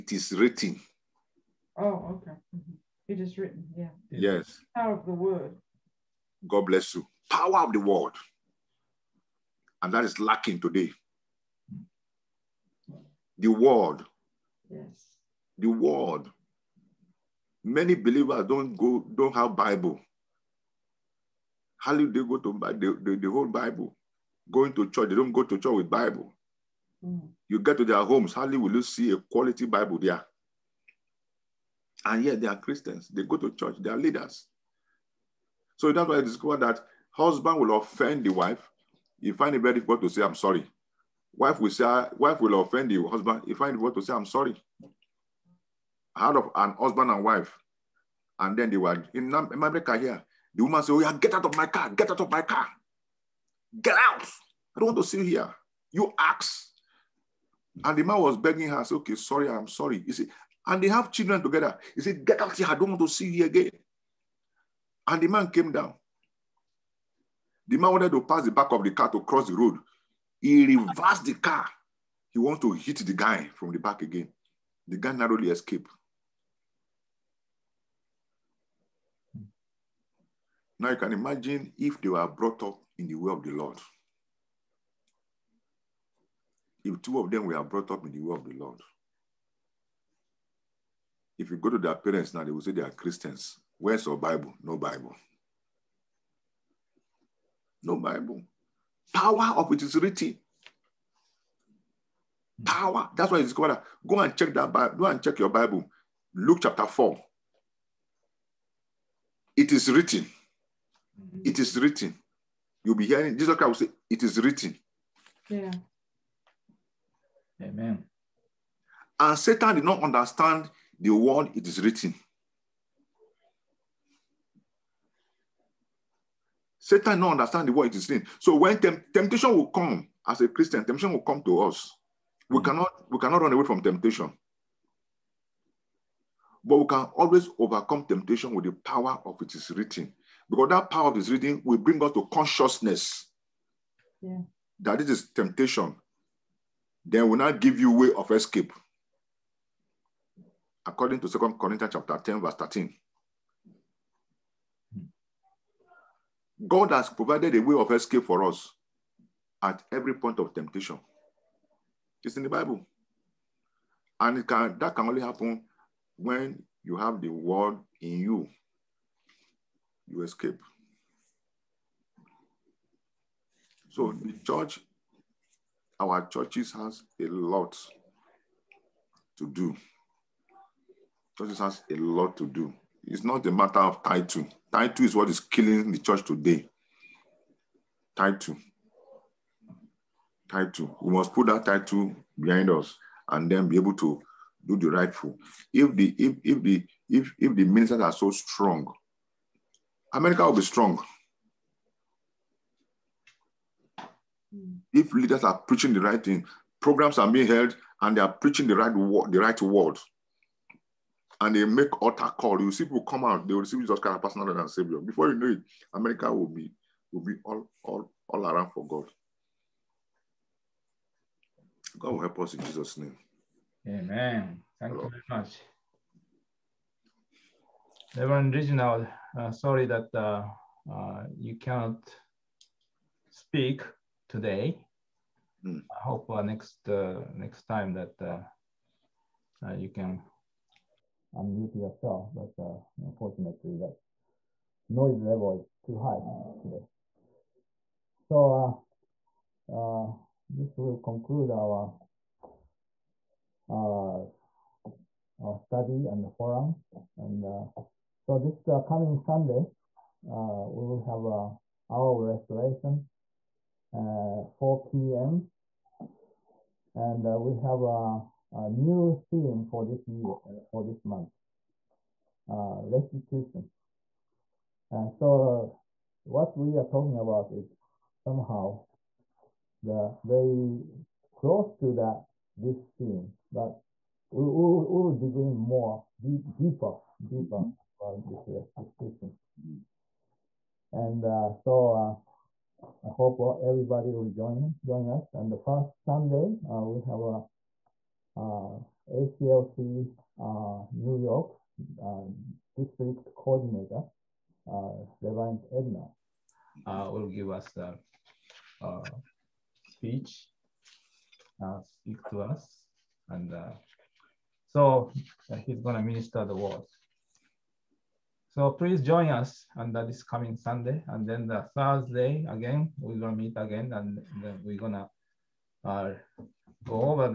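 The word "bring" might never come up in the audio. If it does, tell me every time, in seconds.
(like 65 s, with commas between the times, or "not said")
141 s.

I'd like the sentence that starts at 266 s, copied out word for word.
And uh, we have a, a, new theme for this year, uh, for this month, restitution.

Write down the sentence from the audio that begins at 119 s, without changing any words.
And Satan did not understand the word it is written.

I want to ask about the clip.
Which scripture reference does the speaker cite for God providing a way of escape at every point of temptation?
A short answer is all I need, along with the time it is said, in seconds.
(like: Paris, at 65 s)
Second Corinthians 10:13, at 151 s.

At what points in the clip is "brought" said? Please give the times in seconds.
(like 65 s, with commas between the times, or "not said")
82 s, 87 s.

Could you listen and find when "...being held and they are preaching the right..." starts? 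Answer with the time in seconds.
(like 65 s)
207 s.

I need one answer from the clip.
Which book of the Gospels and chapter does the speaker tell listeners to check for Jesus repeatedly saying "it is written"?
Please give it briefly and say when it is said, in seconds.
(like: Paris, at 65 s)
Luke chapter 4, at 106 s.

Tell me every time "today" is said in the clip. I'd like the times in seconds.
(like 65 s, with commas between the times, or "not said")
10 s, 186 s, 234 s, 246 s.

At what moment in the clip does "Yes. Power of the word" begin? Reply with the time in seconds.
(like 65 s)
4 s.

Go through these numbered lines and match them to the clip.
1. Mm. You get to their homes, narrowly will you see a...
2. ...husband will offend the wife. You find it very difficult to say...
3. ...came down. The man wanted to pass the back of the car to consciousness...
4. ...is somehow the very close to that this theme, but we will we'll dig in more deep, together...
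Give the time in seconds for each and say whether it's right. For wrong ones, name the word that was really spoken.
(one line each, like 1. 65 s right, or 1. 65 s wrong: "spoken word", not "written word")
1. 27 s wrong: "hardly", not "narrowly"
2. 37 s right
3. 65 s wrong: "cross", not "consciousness"
4. 277 s wrong: "deeper", not "together".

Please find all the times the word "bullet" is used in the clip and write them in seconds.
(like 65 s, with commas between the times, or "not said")
not said.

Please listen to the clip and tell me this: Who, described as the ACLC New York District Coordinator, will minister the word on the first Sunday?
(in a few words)
Reverend Edna.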